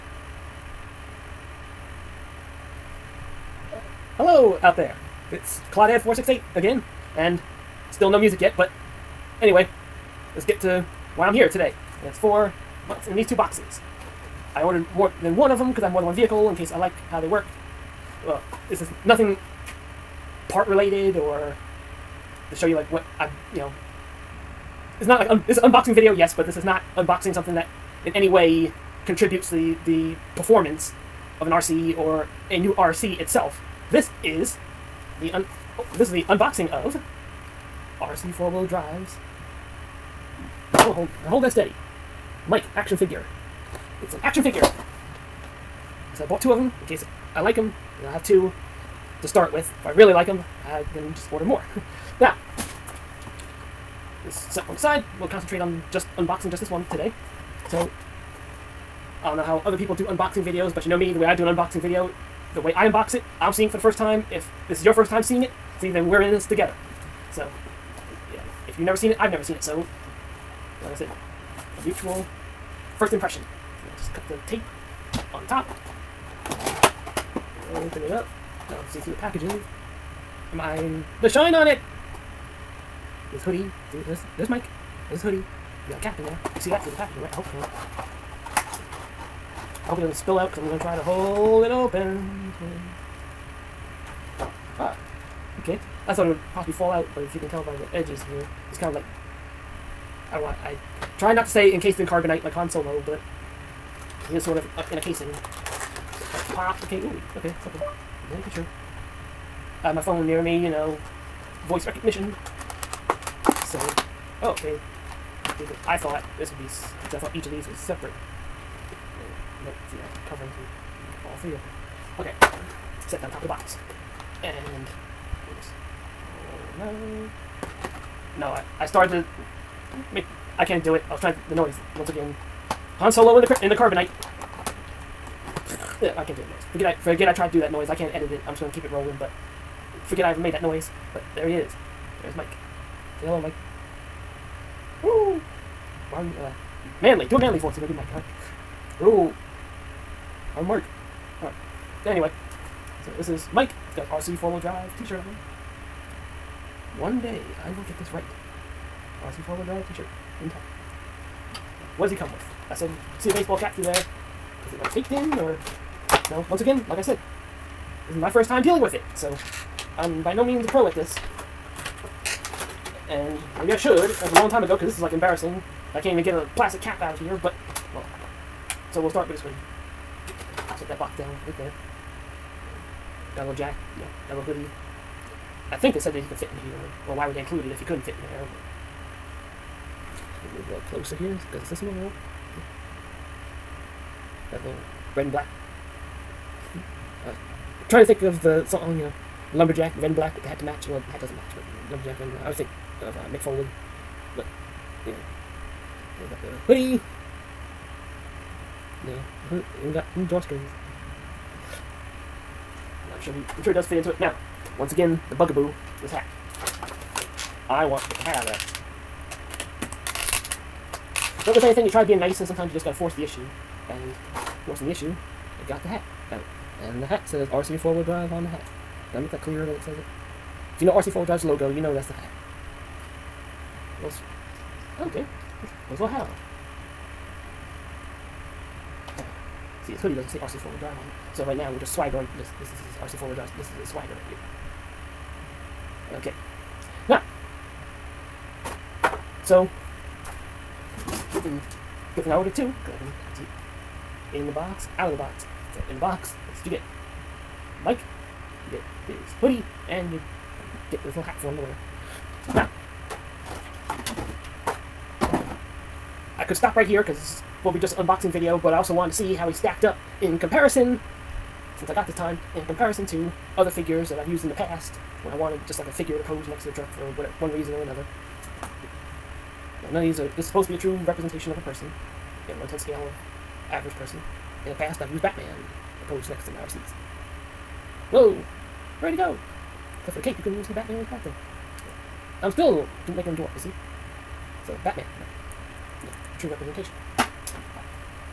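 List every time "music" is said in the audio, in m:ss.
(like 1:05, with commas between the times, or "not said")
0:08.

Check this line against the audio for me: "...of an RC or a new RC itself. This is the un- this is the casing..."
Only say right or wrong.
wrong.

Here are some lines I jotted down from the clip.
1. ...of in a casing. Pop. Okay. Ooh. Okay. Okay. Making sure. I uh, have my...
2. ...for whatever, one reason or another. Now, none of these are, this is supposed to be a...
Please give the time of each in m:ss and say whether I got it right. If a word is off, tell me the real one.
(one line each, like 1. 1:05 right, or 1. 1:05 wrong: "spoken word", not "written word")
1. 1:44 right
2. 4:36 right.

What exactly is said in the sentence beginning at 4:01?
So right now we're just swaggering.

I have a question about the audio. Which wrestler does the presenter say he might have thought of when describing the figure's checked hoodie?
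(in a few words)
Mick Foley.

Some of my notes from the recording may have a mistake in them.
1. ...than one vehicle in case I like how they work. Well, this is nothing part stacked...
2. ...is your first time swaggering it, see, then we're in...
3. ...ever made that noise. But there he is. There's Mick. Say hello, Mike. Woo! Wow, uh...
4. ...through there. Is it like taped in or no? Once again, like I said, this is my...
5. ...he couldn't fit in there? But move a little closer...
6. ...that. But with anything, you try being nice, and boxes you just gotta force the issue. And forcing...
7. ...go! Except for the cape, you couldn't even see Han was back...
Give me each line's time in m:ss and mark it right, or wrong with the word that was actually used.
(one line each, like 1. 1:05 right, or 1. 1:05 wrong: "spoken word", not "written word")
1. 0:16 wrong: "related", not "stacked"
2. 1:04 wrong: "seeing", not "swaggering"
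3. 2:20 wrong: "Mike", not "Mick"
4. 2:43 right
5. 3:07 right
6. 3:41 wrong: "sometimes", not "boxes"
7. 4:49 wrong: "Batman", not "Han".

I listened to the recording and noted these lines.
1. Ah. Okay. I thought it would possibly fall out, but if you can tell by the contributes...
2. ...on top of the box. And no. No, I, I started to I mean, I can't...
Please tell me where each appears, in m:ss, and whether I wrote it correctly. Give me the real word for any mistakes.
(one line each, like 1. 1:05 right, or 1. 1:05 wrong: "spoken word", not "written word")
1. 1:34 wrong: "edges", not "contributes"
2. 2:03 right.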